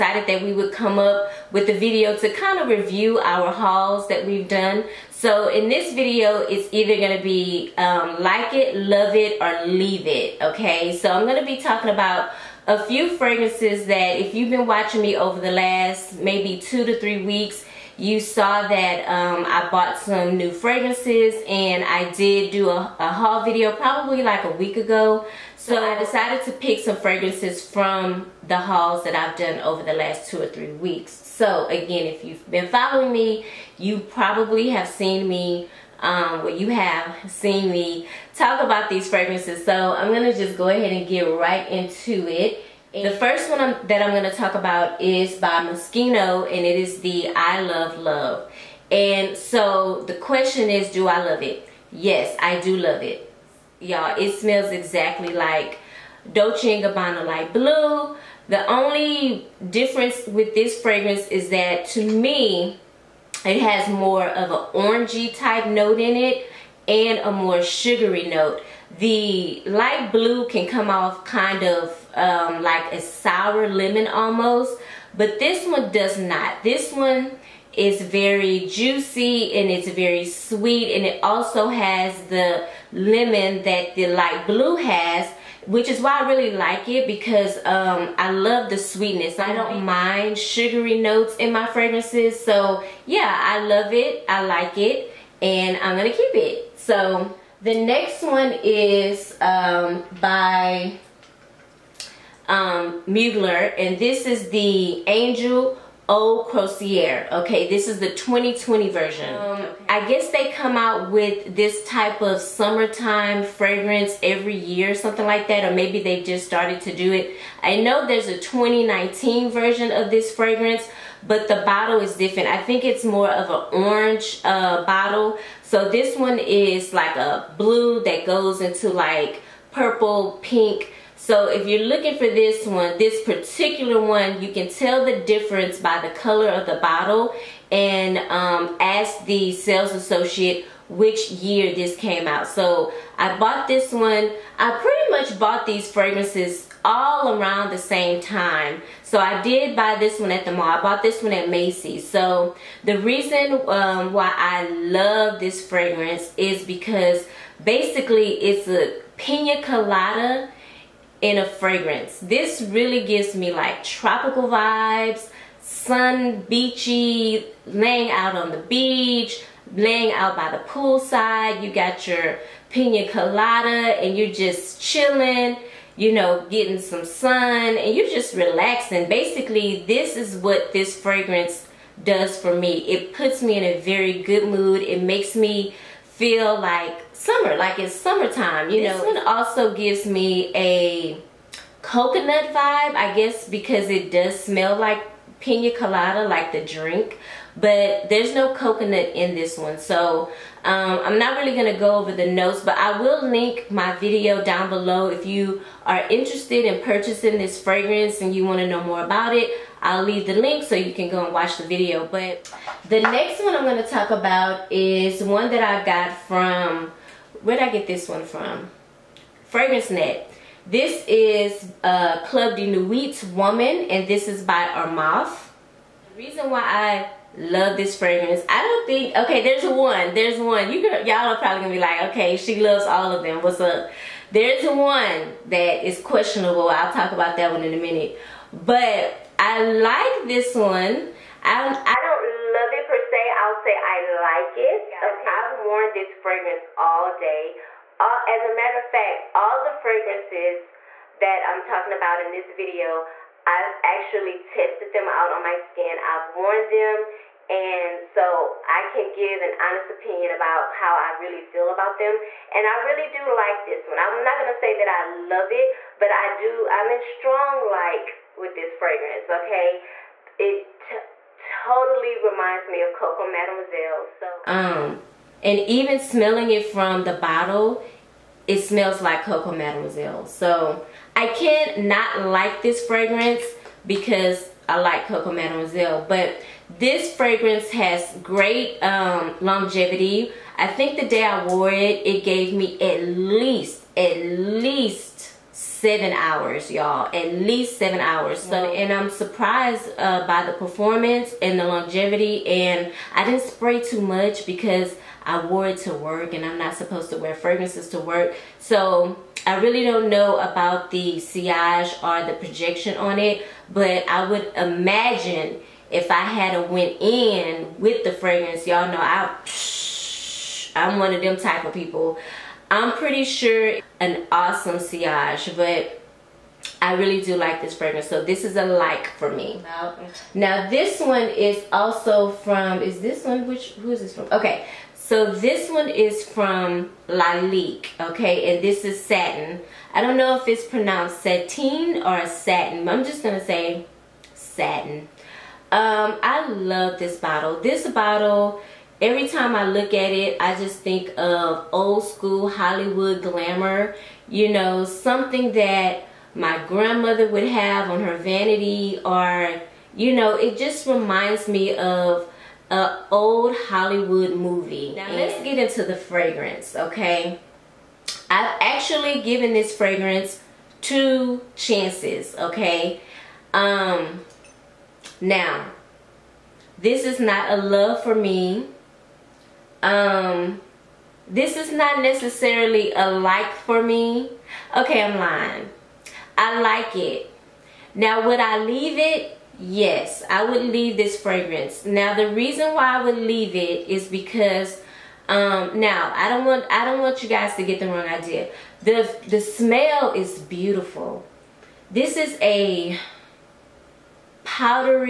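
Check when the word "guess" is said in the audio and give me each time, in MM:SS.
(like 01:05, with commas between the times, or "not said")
01:50, 03:13.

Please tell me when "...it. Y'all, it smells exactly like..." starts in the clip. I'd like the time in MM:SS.
00:53.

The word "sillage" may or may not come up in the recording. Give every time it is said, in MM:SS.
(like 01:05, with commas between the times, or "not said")
05:11, 05:24.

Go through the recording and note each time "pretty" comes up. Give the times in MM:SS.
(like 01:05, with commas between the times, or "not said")
02:24, 05:22.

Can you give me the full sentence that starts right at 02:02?
I think it's more of an orange uh, bottle.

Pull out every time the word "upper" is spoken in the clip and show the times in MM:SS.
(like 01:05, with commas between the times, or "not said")
not said.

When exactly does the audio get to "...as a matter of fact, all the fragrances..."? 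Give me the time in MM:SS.
04:08.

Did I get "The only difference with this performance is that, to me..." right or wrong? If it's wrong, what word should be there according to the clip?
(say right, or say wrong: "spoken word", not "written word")
wrong: "fragrance", not "performance".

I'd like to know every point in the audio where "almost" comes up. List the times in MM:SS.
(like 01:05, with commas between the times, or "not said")
01:14.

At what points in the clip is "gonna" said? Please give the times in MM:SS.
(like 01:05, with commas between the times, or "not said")
03:21, 03:51, 04:24.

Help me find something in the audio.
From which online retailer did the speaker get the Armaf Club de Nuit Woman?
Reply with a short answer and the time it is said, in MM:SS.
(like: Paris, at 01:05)
FragranceNet, at 03:39.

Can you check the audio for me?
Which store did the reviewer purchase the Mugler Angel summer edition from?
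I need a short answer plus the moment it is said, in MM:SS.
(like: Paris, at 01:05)
Macy's, at 02:31.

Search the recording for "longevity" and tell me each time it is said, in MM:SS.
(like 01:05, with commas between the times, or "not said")
04:49, 05:01.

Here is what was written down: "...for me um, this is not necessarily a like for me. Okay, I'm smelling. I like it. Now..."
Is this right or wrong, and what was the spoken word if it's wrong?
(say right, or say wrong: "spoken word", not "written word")
wrong: "lying", not "smelling".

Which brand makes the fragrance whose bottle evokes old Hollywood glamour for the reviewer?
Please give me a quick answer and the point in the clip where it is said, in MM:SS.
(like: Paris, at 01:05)
Lalique, at 05:37.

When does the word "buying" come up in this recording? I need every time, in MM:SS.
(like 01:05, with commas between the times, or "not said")
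not said.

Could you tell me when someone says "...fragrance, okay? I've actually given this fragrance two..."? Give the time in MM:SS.
06:05.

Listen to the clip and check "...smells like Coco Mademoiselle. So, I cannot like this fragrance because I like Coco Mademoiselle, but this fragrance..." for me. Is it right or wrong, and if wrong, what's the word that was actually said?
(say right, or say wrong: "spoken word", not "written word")
right.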